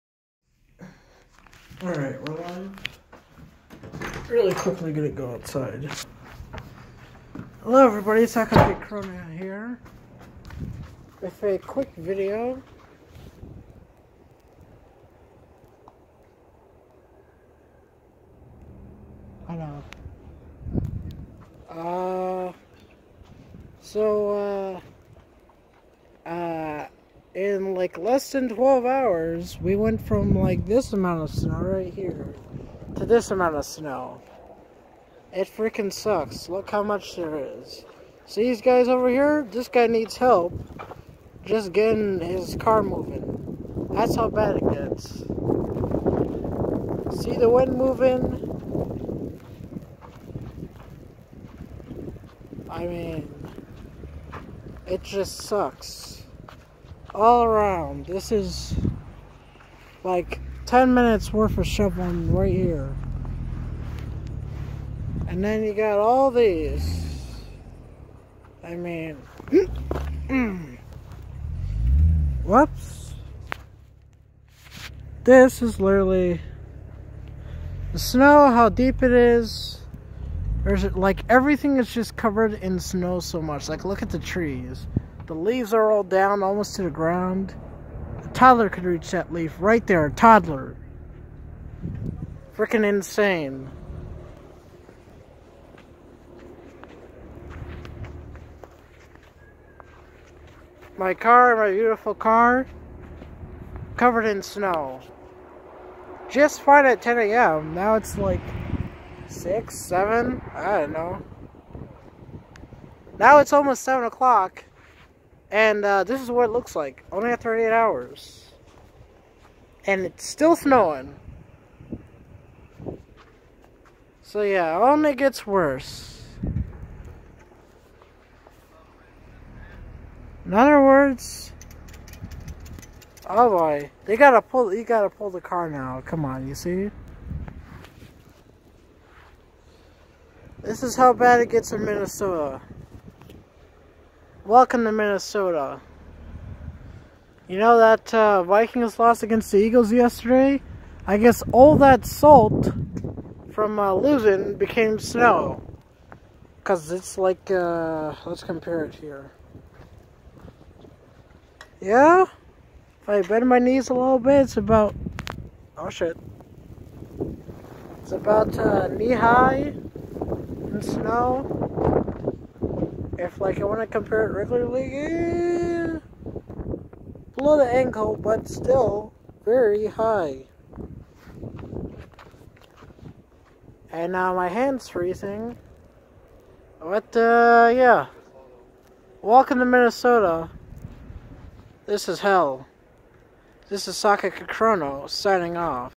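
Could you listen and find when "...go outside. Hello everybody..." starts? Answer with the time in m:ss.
0:05.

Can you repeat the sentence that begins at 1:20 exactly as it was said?
There's like everything is just covered in snow so much.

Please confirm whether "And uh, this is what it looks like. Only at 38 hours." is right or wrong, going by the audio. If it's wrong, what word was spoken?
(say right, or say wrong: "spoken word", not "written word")
right.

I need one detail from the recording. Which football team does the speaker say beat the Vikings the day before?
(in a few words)
Eagles.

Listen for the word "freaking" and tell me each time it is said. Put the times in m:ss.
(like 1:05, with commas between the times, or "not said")
0:35, 1:32.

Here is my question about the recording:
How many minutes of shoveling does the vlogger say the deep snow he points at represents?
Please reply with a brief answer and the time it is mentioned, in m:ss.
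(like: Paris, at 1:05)
10, at 1:00.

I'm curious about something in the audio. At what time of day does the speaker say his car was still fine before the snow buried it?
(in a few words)
10 a.m.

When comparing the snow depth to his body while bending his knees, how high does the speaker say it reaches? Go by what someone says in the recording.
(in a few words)
knee high.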